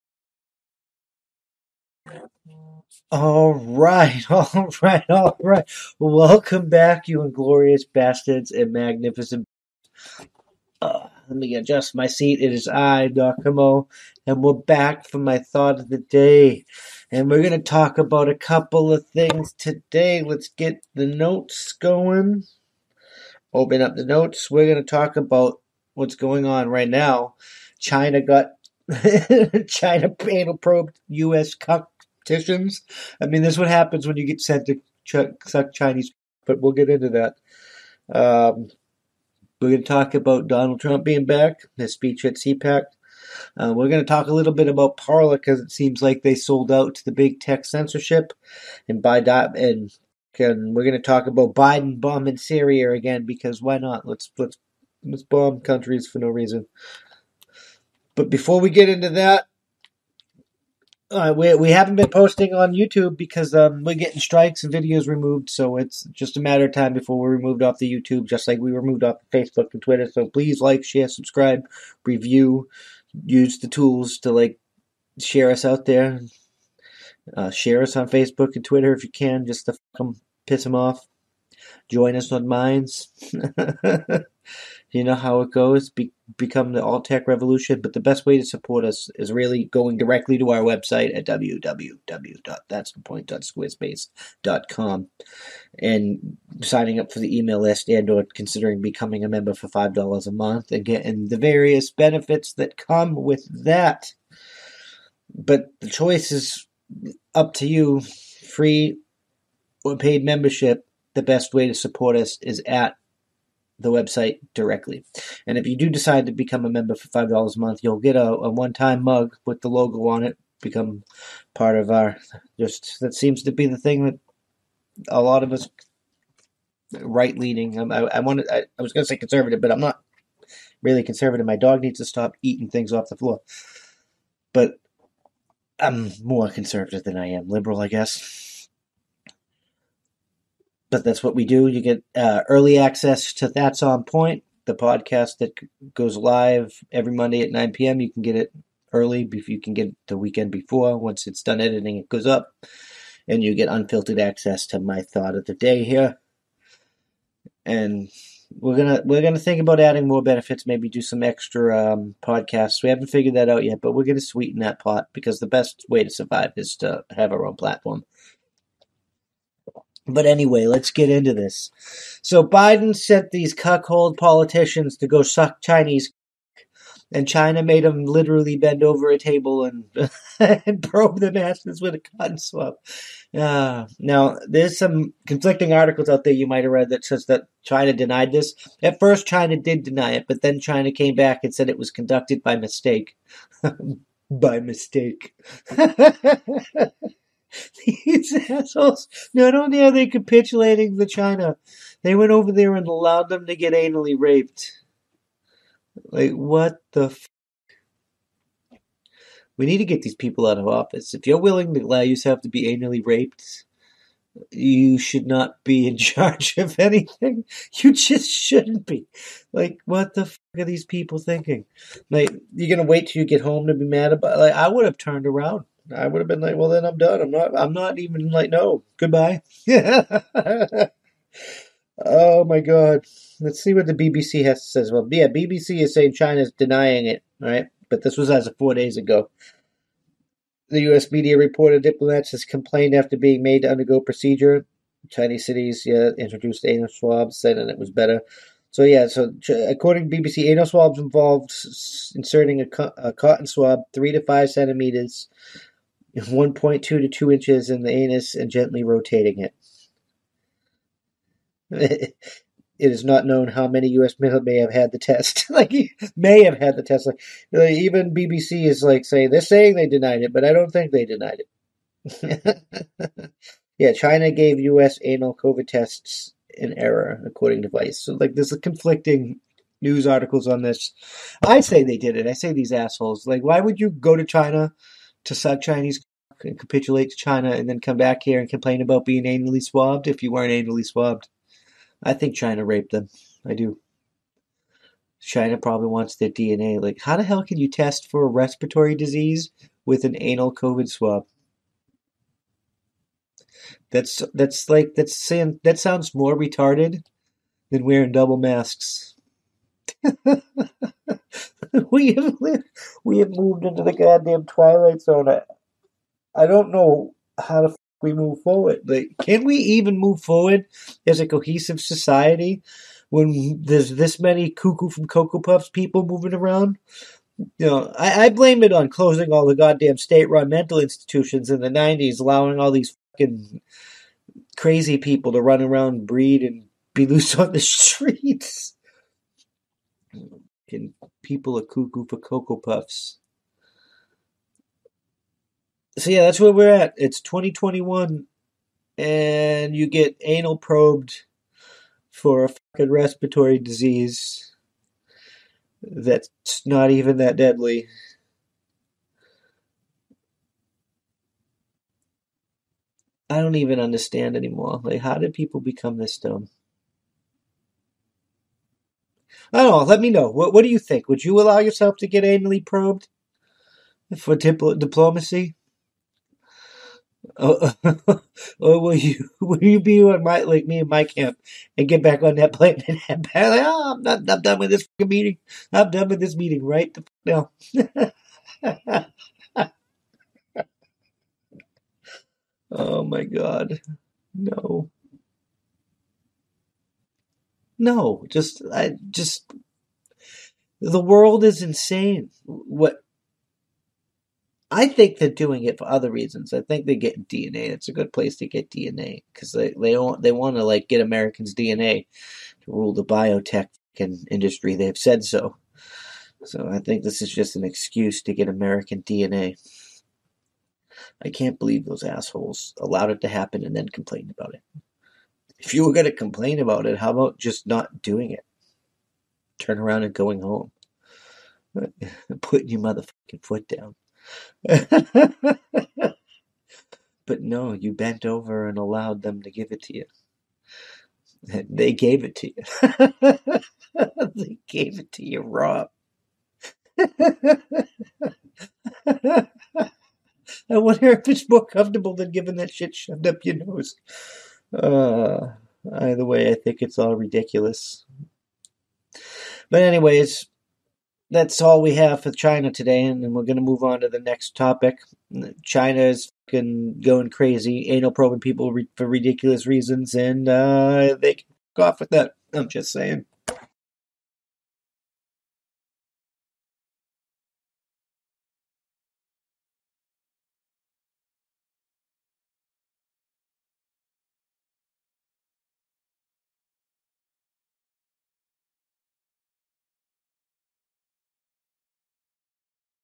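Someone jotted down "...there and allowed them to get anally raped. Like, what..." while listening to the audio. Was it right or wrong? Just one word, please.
right.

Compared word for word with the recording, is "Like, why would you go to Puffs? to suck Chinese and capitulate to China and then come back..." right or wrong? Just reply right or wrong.
wrong.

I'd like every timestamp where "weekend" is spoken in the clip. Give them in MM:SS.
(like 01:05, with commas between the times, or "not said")
02:30.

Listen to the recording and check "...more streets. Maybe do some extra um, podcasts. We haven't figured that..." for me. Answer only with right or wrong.
wrong.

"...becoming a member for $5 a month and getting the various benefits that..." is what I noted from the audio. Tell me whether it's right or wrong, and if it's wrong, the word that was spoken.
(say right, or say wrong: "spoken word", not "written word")
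right.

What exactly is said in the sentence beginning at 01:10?
So please like, share, subscribe, review, use the tools to like share us out there.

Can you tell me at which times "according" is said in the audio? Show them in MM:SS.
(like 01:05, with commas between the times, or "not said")
04:09, 04:37.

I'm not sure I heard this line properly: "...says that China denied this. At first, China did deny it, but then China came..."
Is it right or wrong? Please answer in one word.
right.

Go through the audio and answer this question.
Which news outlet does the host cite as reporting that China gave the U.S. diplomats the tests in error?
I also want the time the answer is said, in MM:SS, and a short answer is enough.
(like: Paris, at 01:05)
Vice, at 04:37.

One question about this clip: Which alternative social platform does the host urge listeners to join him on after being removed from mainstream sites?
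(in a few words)
Minds.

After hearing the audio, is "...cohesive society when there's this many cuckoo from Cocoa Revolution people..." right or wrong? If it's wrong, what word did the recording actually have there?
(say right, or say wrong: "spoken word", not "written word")
wrong: "Puffs", not "Revolution".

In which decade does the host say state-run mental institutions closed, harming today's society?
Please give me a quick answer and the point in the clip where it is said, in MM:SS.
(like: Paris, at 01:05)
1990s, at 05:31.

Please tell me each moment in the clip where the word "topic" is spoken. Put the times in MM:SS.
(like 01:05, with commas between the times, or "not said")
07:44.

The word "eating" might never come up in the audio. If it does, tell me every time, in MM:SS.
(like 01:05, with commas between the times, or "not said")
02:12.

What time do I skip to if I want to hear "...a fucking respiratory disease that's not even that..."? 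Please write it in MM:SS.
05:52.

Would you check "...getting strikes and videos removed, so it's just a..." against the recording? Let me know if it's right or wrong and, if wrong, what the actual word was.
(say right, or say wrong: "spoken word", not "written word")
right.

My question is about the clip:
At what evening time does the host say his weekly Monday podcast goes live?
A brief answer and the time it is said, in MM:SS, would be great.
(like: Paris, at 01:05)
9 p.m., at 02:27.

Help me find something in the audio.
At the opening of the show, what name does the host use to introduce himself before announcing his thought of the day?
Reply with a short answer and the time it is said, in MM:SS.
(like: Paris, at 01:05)
Doc Comeau, at 00:13.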